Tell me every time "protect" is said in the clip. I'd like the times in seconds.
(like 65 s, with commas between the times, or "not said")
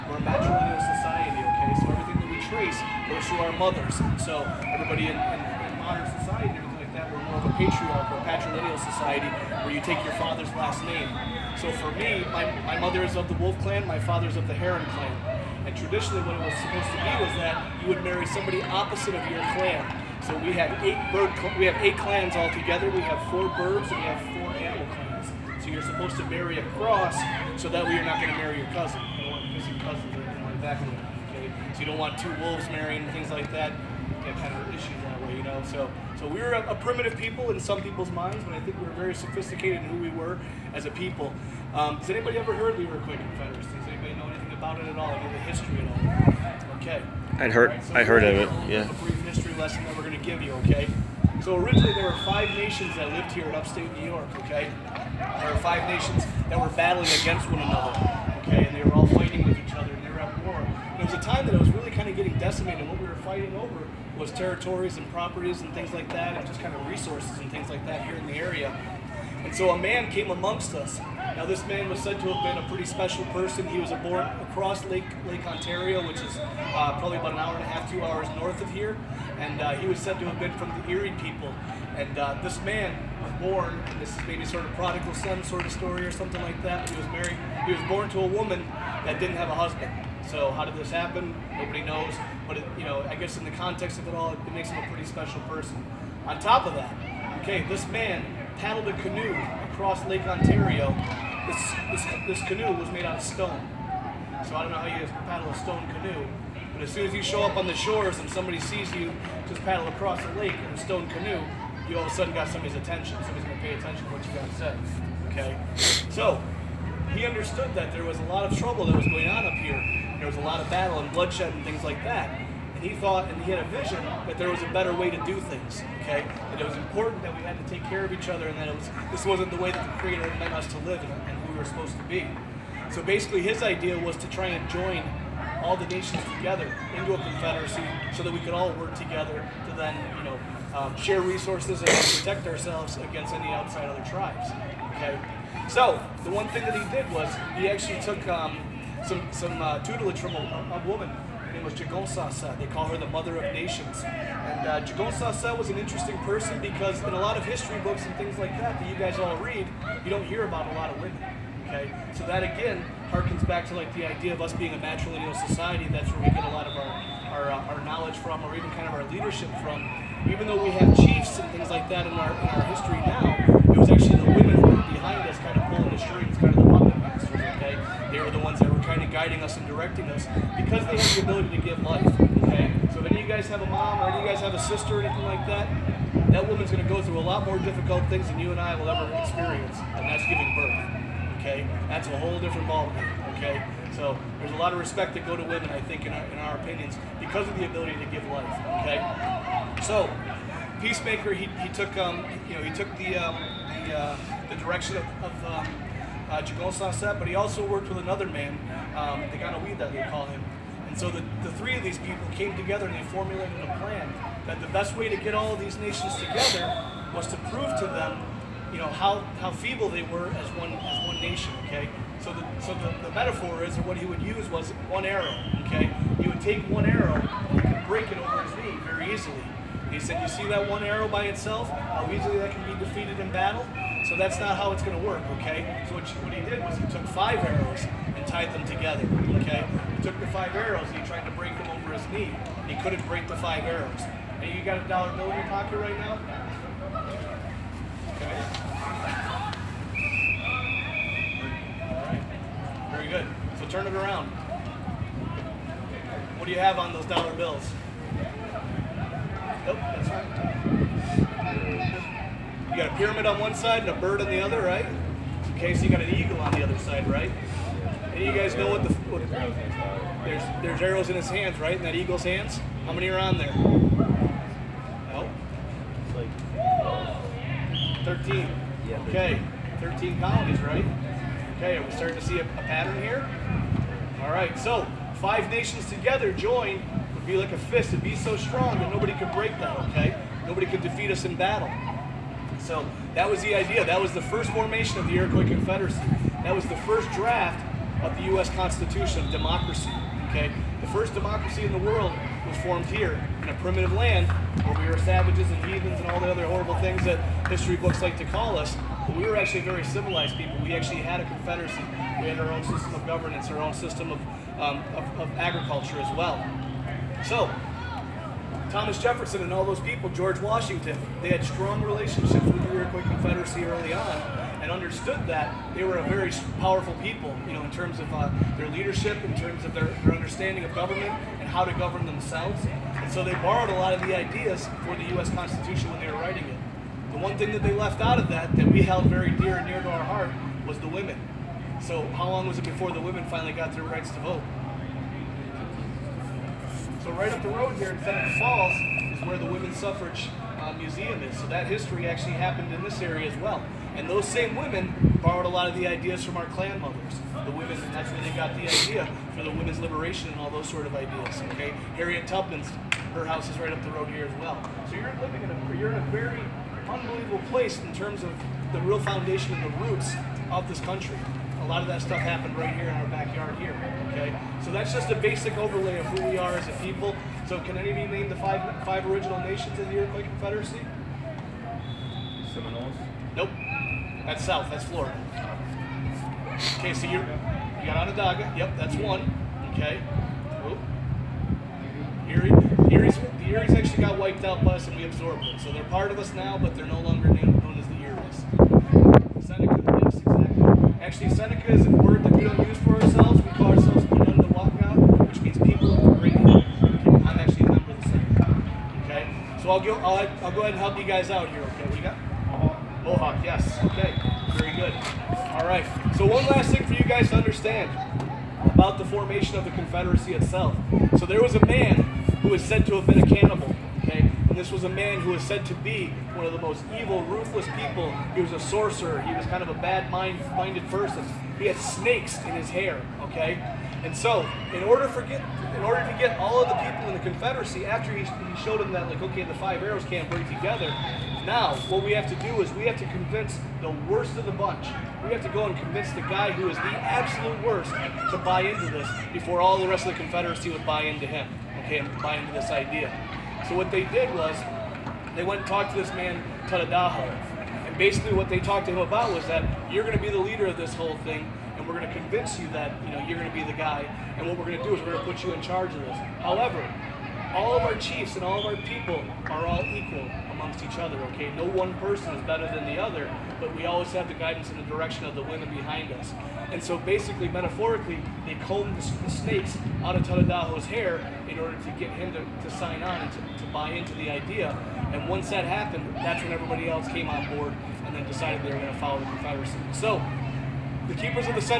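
141 s.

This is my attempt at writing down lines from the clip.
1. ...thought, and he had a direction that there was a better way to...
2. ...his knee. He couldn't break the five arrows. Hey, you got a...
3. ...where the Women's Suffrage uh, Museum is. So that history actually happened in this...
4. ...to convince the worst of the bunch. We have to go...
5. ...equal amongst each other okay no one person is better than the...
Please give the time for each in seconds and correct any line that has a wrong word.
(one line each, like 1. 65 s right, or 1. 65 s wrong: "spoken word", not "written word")
1. 122 s wrong: "vision", not "direction"
2. 241 s right
3. 349 s right
4. 442 s right
5. 469 s right.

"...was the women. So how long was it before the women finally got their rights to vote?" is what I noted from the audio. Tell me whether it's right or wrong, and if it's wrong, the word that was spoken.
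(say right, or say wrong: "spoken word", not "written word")
right.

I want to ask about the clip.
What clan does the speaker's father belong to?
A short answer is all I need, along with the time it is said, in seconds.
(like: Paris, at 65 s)
Heron clan, at 14 s.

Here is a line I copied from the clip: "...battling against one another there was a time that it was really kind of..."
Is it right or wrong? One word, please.
right.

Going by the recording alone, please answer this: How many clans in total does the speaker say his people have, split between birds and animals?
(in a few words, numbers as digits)
8.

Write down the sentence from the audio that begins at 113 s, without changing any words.
Somebody's gonna pay attention to what you got to say.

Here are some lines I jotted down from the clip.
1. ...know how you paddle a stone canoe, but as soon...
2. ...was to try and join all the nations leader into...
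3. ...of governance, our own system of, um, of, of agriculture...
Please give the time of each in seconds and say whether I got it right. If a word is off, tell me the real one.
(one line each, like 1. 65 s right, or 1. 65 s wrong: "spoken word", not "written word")
1. 104 s right
2. 133 s wrong: "together", not "leader"
3. 312 s right.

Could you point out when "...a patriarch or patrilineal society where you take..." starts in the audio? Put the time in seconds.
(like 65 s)
7 s.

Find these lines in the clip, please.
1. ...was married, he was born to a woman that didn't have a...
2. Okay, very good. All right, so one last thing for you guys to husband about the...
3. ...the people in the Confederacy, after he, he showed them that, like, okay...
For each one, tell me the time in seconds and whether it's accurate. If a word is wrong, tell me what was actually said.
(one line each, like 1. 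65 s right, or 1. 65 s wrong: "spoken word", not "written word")
1. 86 s right
2. 413 s wrong: "understand", not "husband"
3. 436 s right.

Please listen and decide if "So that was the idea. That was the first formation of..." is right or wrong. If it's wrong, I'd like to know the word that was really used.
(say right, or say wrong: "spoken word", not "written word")
right.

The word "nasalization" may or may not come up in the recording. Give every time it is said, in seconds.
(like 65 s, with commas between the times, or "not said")
not said.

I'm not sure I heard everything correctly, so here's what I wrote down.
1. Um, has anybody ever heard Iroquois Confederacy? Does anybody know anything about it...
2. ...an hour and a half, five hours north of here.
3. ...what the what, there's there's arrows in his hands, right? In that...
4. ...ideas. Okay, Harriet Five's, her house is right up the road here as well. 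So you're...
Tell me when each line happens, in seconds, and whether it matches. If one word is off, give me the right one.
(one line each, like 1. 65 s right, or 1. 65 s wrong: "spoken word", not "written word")
1. 41 s right
2. 77 s wrong: "two", not "five"
3. 268 s right
4. 360 s wrong: "Tubman", not "Five".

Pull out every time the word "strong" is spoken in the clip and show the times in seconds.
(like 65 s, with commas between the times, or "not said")
288 s, 321 s.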